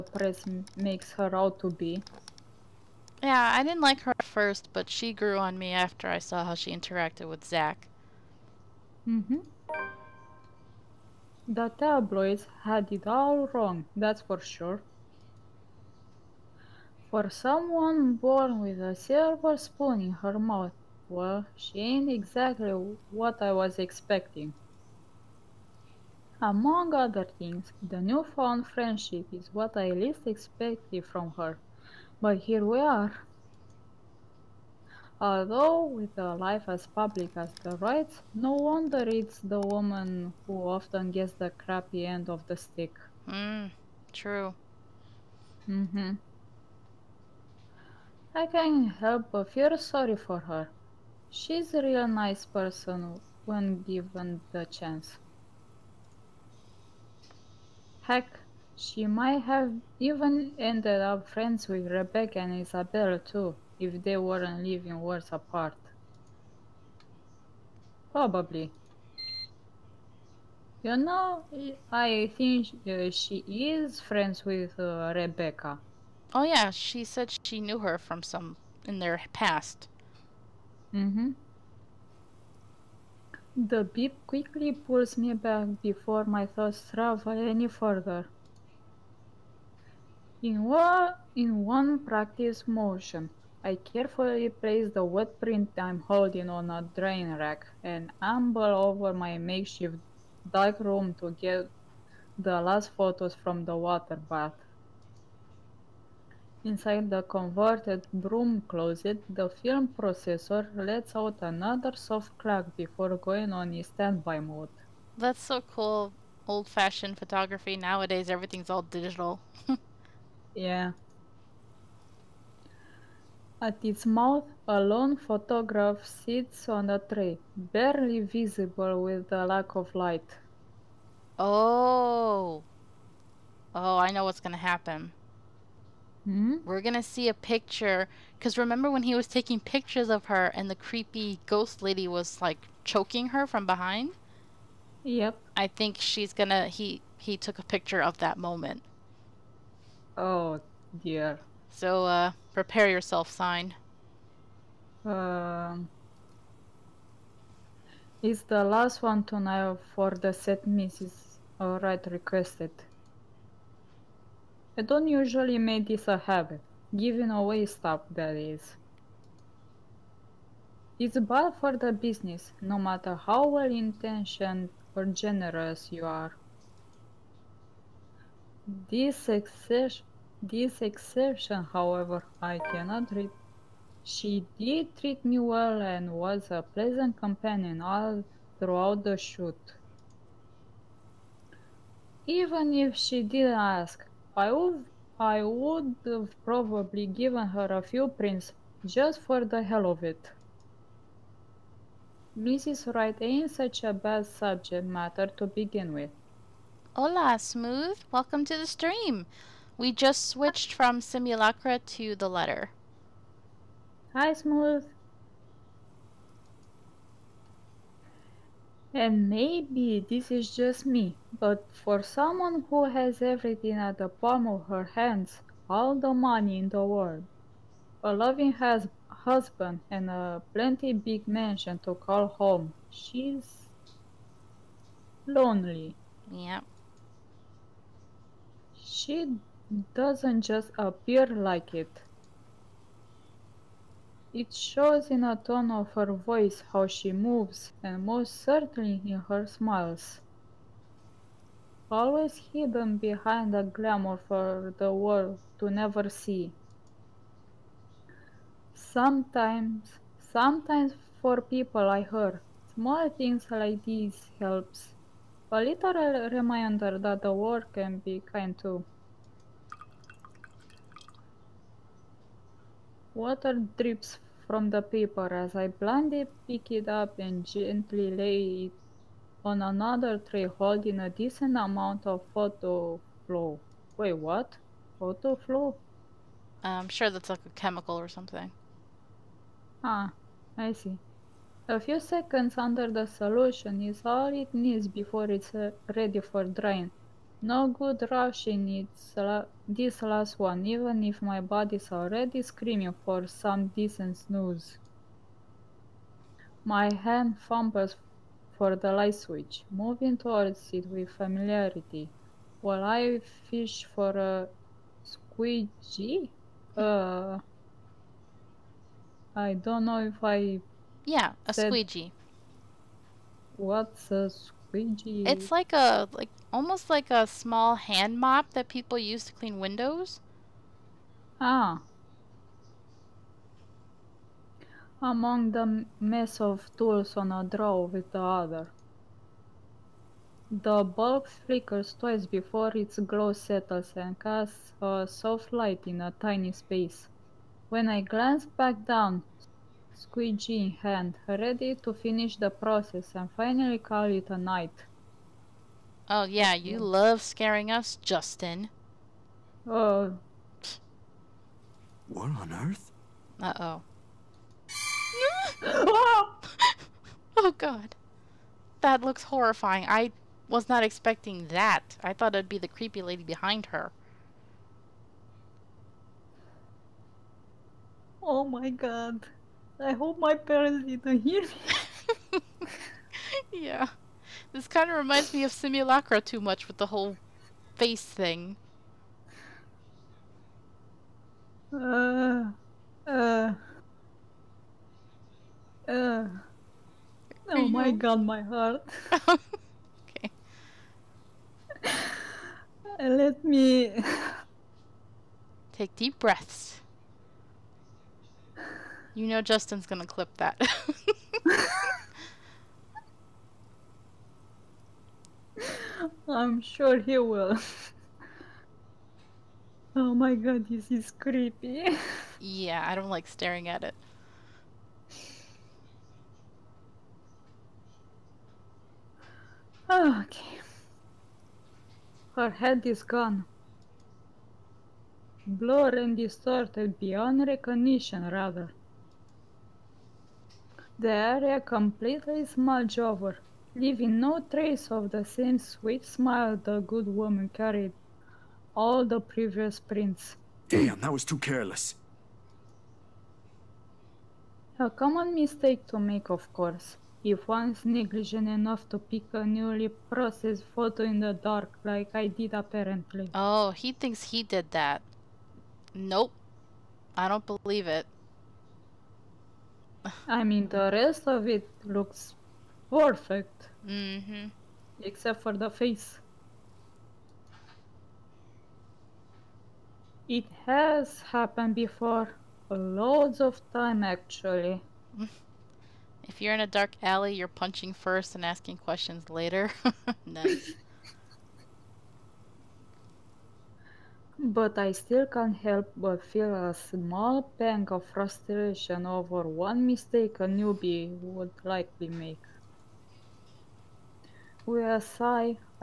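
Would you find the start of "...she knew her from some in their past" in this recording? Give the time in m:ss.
1:17.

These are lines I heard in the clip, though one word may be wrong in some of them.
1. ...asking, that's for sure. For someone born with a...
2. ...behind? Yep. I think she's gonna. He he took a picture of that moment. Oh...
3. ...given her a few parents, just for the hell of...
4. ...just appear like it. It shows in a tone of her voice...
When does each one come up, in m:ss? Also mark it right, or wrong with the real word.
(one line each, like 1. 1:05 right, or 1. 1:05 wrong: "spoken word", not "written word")
1. 0:13 wrong: "wrong", not "asking"
2. 2:23 right
3. 3:17 wrong: "prints", not "parents"
4. 4:00 right.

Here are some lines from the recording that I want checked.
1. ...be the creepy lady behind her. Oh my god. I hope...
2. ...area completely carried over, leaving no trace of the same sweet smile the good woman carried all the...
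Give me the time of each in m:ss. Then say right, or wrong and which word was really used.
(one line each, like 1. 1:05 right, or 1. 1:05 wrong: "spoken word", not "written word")
1. 6:12 right
2. 7:21 wrong: "smudged", not "carried".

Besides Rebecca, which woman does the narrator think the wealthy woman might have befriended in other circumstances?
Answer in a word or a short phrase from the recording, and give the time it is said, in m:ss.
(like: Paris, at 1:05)
Isabel, at 1:02.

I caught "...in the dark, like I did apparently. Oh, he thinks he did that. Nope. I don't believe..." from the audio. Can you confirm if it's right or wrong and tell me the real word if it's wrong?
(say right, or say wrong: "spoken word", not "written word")
right.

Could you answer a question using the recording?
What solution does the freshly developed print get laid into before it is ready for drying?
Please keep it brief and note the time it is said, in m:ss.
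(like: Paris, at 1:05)
Photo-Flo, at 4:42.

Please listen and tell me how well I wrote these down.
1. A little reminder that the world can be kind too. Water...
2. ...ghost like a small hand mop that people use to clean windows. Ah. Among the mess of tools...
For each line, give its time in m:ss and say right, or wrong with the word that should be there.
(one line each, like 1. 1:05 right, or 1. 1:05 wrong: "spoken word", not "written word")
1. 4:25 right
2. 5:26 wrong: "almost", not "ghost".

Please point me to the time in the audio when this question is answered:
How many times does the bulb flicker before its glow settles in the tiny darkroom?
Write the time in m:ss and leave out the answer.
5:41.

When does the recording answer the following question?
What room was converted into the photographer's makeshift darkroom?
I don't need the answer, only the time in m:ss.
1:48.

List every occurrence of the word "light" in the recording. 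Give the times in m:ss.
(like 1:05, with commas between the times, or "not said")
2:09, 5:08, 5:45.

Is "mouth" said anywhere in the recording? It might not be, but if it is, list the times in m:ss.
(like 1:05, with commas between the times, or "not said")
0:20, 2:04.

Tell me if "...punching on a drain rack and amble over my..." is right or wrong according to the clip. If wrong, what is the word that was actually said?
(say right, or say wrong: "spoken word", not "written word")
wrong: "holding", not "punching".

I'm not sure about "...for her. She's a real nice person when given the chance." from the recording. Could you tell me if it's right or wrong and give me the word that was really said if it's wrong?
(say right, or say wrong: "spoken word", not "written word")
right.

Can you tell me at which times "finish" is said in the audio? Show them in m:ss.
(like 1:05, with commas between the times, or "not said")
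5:51.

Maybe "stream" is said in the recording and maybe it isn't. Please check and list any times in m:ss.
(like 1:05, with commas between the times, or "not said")
3:28.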